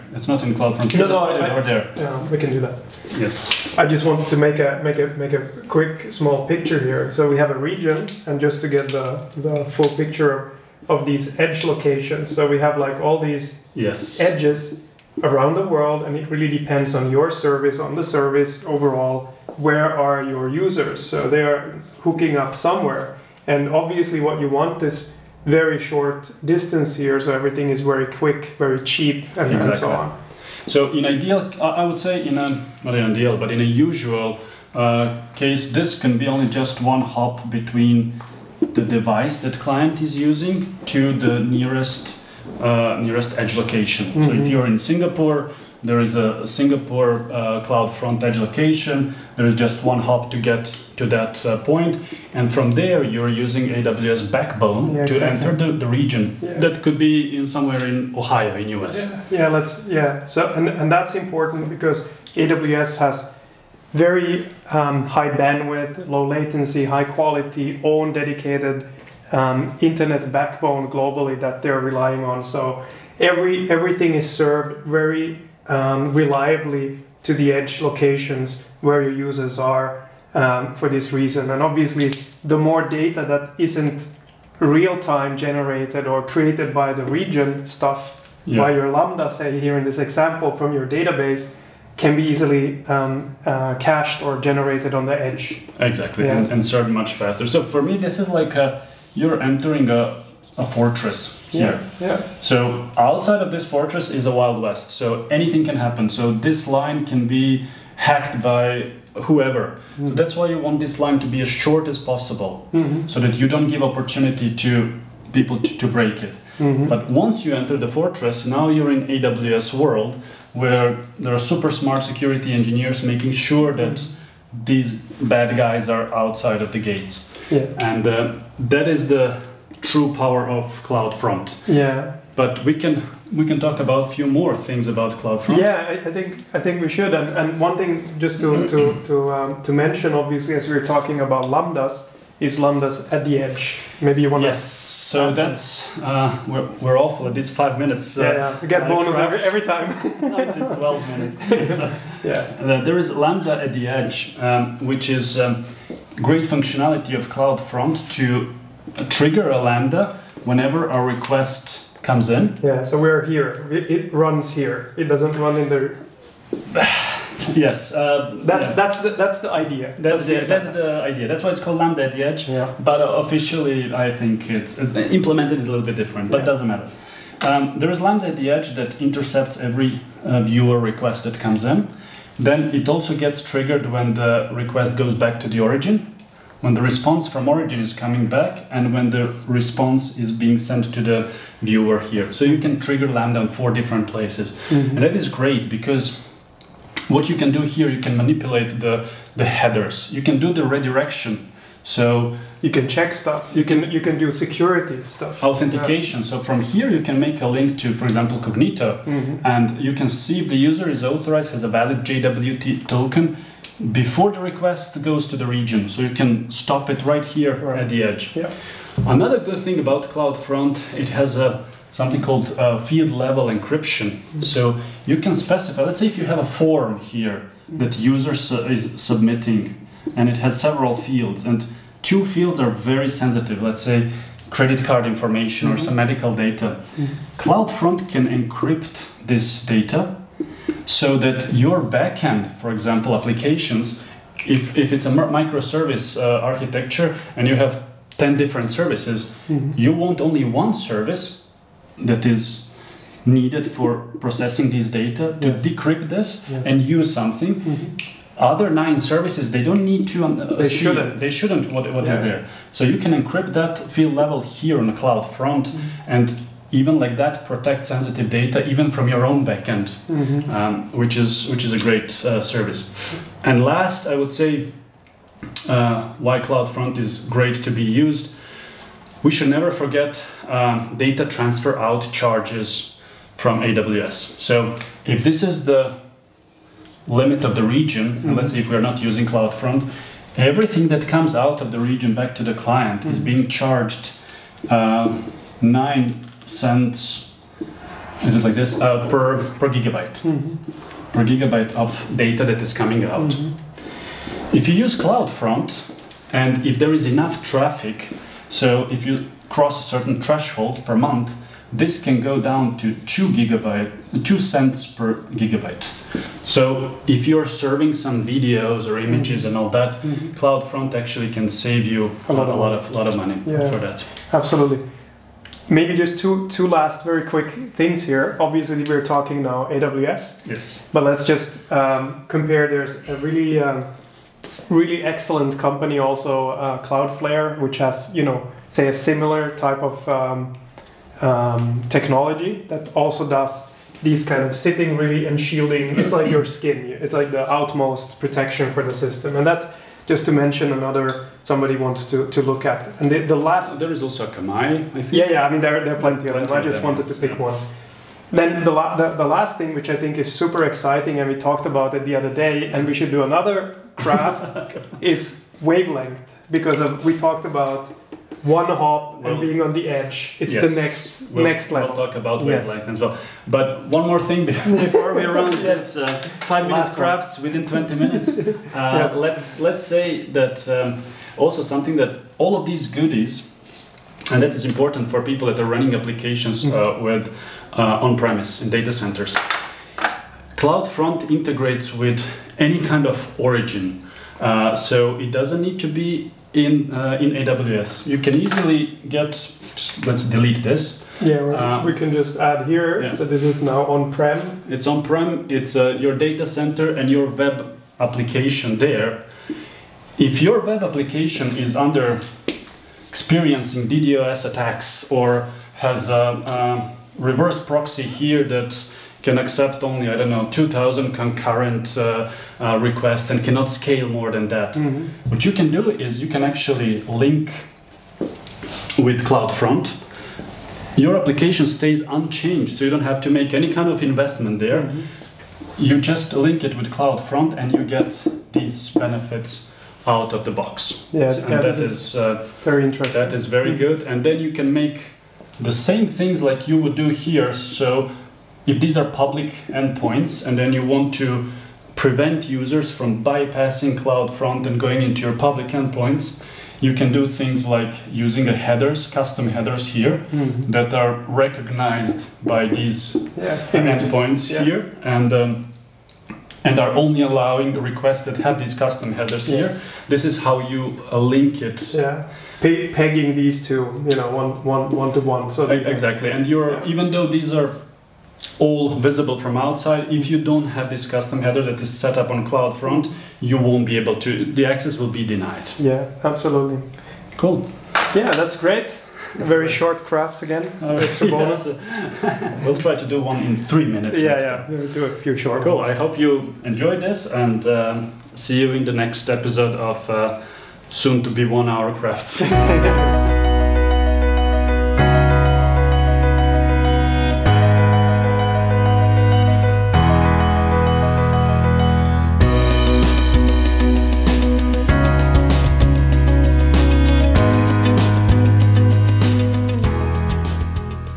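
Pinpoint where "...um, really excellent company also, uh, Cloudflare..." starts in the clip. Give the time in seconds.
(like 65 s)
333 s.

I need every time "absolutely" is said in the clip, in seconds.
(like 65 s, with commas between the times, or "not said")
324 s, 486 s.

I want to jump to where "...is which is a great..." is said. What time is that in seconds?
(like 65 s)
271 s.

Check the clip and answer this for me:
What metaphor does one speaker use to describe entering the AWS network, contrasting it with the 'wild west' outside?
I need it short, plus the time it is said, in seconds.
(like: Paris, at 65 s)
a fortress, at 100 s.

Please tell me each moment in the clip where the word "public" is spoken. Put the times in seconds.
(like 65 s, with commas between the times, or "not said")
449 s, 455 s.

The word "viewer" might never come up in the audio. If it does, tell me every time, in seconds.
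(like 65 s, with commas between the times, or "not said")
180 s, 191 s.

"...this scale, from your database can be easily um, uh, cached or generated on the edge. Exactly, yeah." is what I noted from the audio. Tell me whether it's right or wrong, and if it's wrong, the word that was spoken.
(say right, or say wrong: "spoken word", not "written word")
wrong: "example", not "scale".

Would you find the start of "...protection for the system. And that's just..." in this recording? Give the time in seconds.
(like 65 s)
348 s.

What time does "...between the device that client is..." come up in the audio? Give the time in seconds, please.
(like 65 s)
37 s.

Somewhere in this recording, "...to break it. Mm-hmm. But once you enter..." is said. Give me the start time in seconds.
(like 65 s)
115 s.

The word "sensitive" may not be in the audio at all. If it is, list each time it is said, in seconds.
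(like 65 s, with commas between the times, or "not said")
233 s, 267 s.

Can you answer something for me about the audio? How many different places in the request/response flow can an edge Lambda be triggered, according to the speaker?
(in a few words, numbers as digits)
4.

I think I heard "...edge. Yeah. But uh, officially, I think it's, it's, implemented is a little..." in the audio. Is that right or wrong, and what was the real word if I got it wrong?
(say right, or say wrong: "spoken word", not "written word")
right.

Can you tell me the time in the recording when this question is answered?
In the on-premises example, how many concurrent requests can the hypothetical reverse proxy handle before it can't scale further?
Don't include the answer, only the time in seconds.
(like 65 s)
420 s.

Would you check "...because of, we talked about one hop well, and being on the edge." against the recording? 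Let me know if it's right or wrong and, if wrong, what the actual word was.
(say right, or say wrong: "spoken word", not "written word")
right.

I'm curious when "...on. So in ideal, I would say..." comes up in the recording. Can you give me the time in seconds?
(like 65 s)
29 s.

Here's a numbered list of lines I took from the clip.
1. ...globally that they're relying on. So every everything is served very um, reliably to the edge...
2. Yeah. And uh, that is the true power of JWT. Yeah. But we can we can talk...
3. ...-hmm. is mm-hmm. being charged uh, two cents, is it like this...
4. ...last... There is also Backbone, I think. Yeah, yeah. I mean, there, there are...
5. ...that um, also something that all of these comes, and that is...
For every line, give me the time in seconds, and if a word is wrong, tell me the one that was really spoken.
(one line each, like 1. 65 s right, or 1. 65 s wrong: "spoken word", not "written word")
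1. 70 s right
2. 127 s wrong: "CloudFront", not "JWT"
3. 293 s wrong: "nine", not "two"
4. 353 s wrong: "Akamai", not "Backbone"
5. 380 s wrong: "goodies", not "comes".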